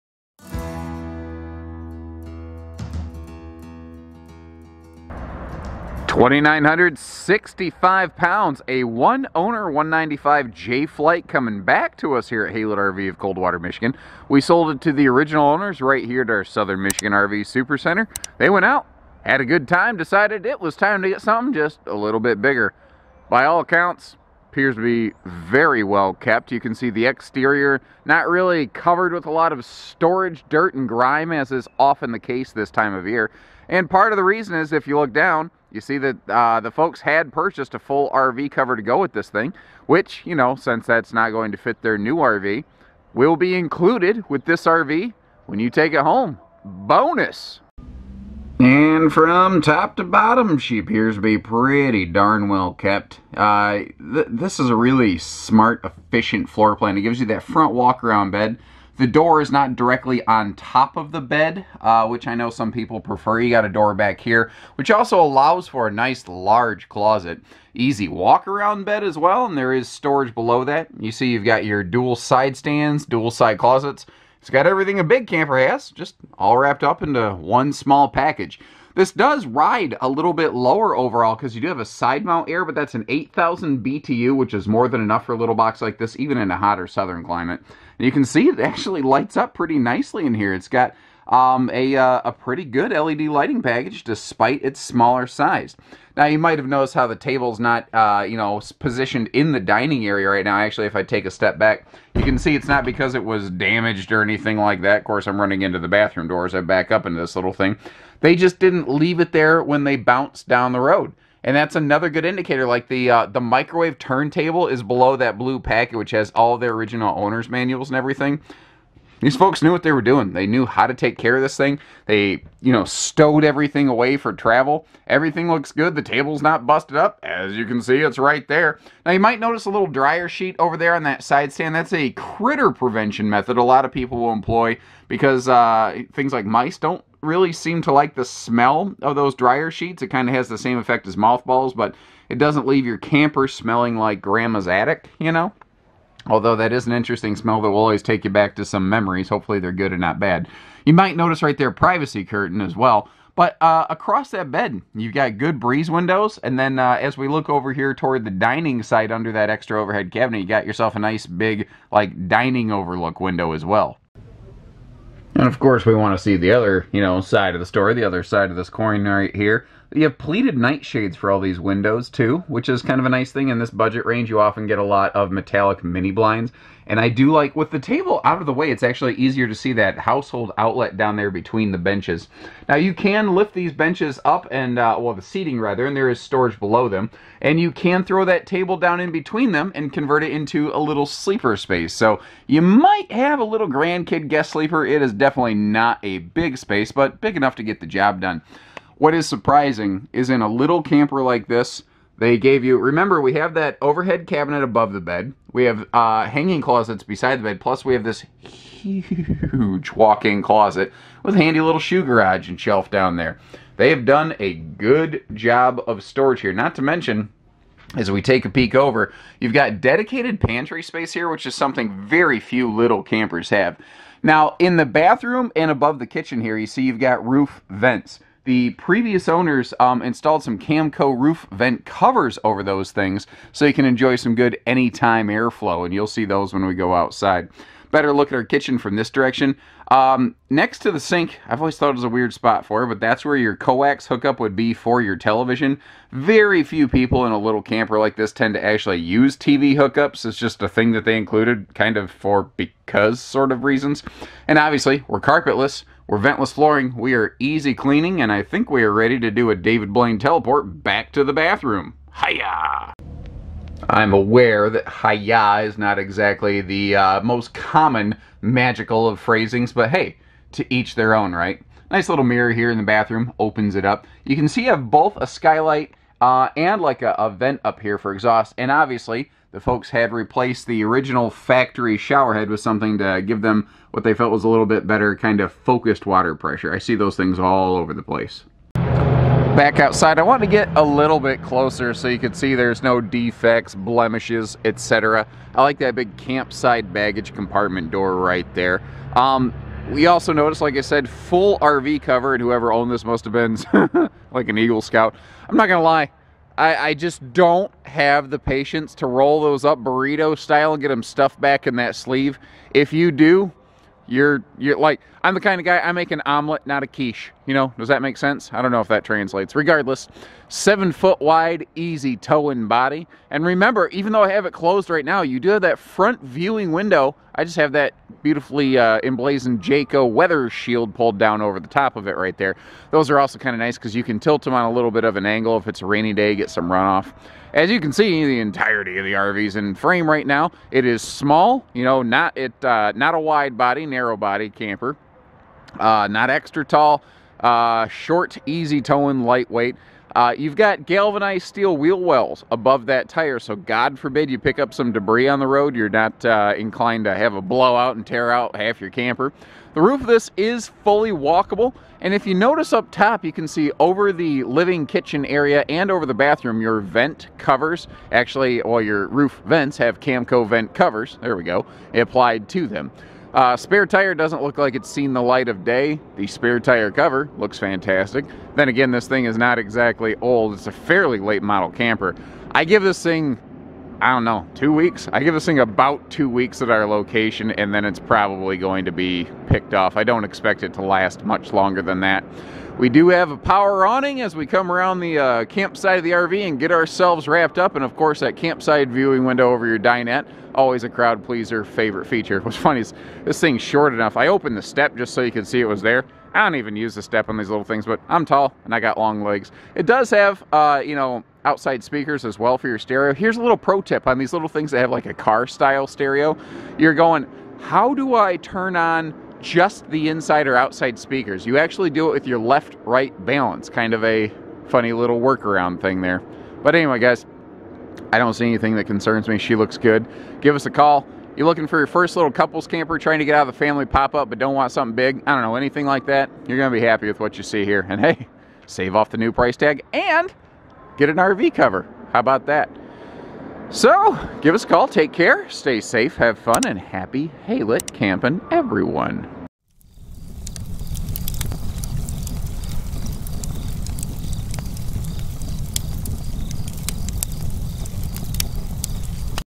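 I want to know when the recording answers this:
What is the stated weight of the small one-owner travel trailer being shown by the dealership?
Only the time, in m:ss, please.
0:06.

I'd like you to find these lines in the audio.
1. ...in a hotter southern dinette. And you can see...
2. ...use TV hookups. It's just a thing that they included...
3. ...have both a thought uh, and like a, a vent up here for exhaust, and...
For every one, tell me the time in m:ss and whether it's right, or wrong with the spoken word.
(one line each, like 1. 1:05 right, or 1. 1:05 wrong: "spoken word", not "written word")
1. 1:26 wrong: "climate", not "dinette"
2. 4:08 right
3. 4:34 wrong: "skylight", not "thought".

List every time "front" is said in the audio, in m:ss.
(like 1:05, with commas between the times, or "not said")
0:57, 5:25.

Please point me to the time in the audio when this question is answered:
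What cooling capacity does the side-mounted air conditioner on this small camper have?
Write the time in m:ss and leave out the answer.
1:23.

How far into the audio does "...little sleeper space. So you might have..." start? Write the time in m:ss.
3:10.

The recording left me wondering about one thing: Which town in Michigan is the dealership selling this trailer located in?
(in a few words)
Coldwater.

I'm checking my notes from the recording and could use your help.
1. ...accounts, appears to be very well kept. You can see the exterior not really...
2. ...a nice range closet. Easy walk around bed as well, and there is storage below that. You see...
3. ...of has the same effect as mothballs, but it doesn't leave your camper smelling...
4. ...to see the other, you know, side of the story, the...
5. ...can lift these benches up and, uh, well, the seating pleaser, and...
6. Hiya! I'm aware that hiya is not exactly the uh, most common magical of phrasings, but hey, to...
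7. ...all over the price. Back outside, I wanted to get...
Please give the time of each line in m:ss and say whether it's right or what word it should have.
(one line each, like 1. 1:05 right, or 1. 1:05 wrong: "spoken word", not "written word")
1. 0:23 right
2. 1:05 wrong: "large", not "range"
3. 2:20 right
4. 2:46 right
5. 3:02 wrong: "rather", not "pleaser"
6. 4:22 right
7. 4:47 wrong: "place", not "price".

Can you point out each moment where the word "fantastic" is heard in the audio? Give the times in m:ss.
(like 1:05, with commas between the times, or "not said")
6:17.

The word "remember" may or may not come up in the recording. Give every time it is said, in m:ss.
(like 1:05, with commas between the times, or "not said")
3:22, 5:23.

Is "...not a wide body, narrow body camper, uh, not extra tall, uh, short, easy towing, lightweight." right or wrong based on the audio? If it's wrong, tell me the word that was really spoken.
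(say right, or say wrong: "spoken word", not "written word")
right.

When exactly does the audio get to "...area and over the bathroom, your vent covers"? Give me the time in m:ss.
6:05.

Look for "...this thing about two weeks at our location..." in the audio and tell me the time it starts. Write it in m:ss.
6:25.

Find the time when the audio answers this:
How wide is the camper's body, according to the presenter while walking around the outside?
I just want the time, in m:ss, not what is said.
5:20.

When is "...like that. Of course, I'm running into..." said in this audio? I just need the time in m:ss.
1:44.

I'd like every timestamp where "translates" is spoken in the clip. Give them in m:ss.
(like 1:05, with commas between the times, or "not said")
5:19.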